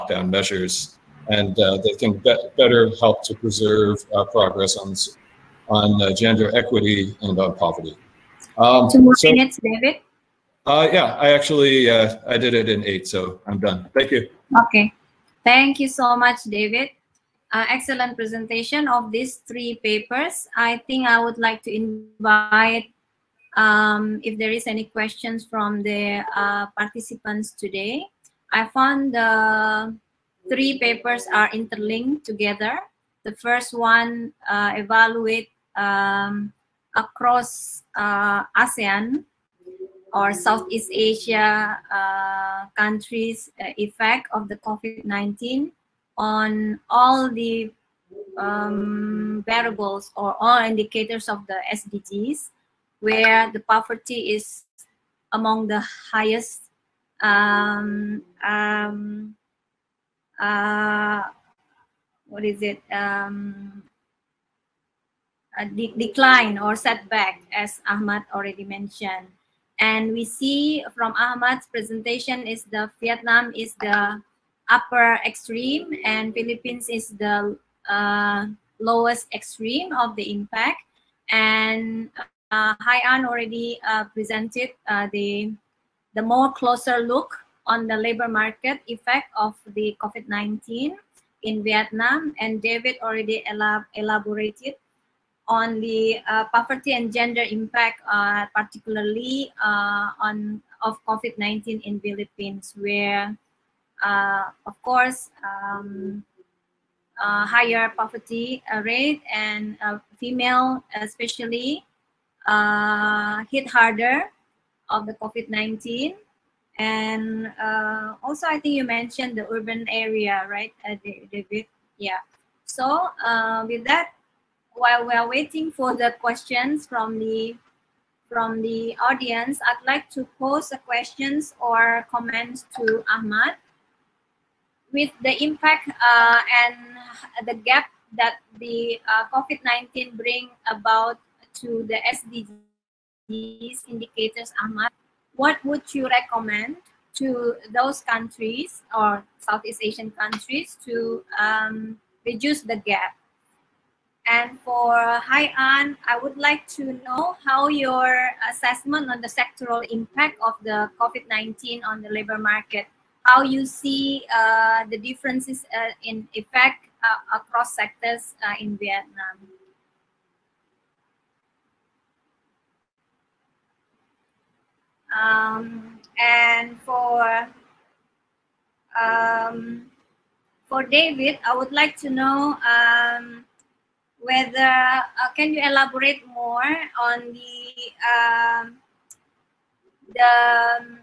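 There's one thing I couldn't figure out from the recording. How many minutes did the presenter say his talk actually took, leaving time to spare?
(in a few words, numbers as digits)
8.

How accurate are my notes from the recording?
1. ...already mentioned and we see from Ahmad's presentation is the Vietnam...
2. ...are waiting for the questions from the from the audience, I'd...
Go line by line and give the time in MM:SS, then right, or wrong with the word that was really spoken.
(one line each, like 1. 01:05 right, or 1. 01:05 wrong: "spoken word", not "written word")
1. 01:08 right
2. 02:05 right.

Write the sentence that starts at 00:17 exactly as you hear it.
Uh, excellent presentation of these three papers.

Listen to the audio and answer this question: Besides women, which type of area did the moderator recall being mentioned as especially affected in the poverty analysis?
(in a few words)
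urban area.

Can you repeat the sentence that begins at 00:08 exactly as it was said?
Um, Two more so minutes, David.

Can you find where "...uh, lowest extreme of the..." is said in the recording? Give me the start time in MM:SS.
01:17.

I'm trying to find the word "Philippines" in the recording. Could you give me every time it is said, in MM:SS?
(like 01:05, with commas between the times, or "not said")
01:16, 01:41.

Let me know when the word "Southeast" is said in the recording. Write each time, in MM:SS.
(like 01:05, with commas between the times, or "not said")
00:40, 02:29.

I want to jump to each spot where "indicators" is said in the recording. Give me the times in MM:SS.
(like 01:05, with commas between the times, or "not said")
00:50, 02:23.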